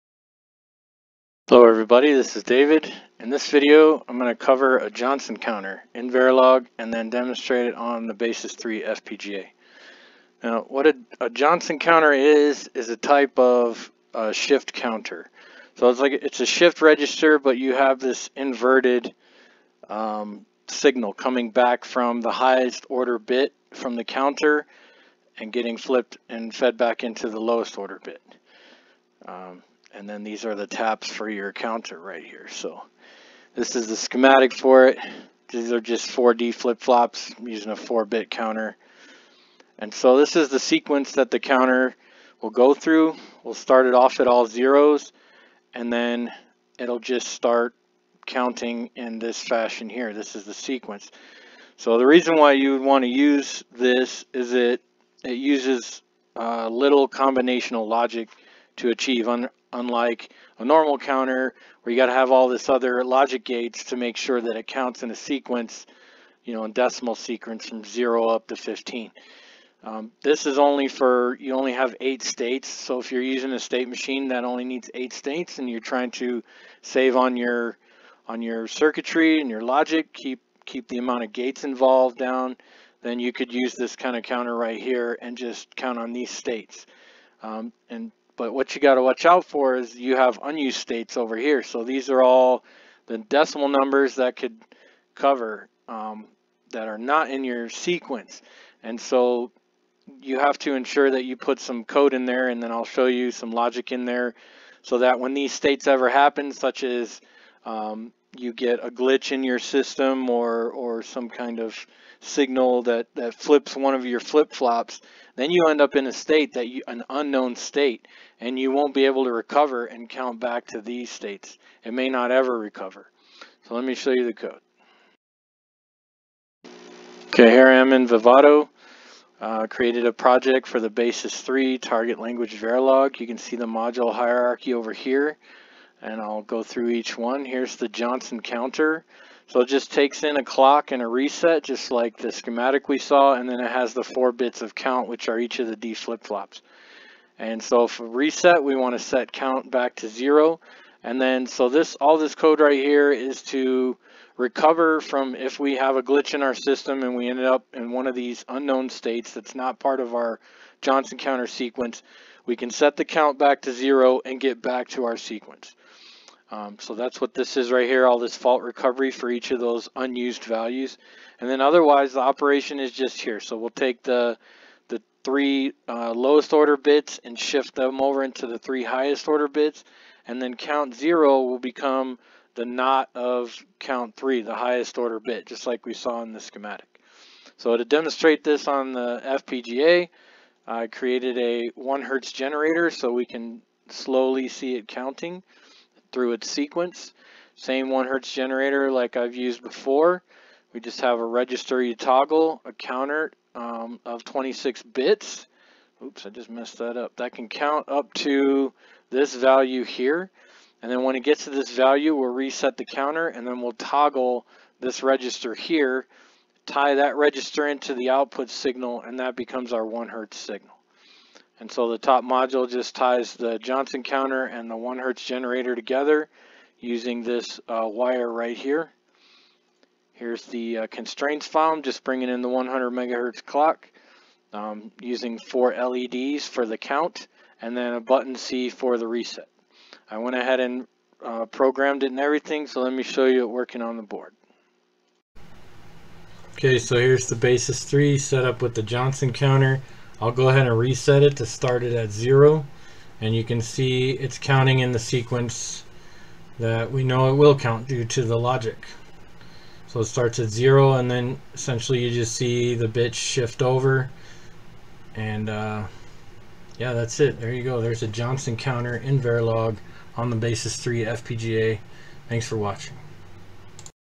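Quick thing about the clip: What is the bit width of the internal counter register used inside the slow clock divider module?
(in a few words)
26 bits.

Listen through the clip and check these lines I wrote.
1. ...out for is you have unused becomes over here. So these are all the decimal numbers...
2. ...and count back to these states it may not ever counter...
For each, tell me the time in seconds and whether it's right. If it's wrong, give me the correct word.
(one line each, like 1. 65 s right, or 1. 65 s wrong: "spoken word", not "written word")
1. 89 s wrong: "states", not "becomes"
2. 119 s wrong: "recover", not "counter".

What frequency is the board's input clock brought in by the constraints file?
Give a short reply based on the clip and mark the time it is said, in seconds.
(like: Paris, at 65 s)
100 megahertz, at 232 s.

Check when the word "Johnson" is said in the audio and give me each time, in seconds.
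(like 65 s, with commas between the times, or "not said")
4 s, 11 s, 137 s, 160 s, 223 s, 248 s, 268 s.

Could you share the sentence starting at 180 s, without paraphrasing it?
And then count zero will become the not of count three, the highest order bit, just like we saw in the schematic.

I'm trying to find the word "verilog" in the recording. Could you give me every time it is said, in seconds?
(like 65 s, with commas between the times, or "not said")
6 s, 132 s, 269 s.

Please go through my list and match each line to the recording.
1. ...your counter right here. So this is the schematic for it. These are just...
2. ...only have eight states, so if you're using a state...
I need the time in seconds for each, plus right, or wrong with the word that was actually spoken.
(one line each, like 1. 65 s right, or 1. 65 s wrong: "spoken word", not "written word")
1. 31 s right
2. 71 s right.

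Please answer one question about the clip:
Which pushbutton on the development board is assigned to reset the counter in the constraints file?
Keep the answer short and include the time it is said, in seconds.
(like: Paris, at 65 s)
button C, at 238 s.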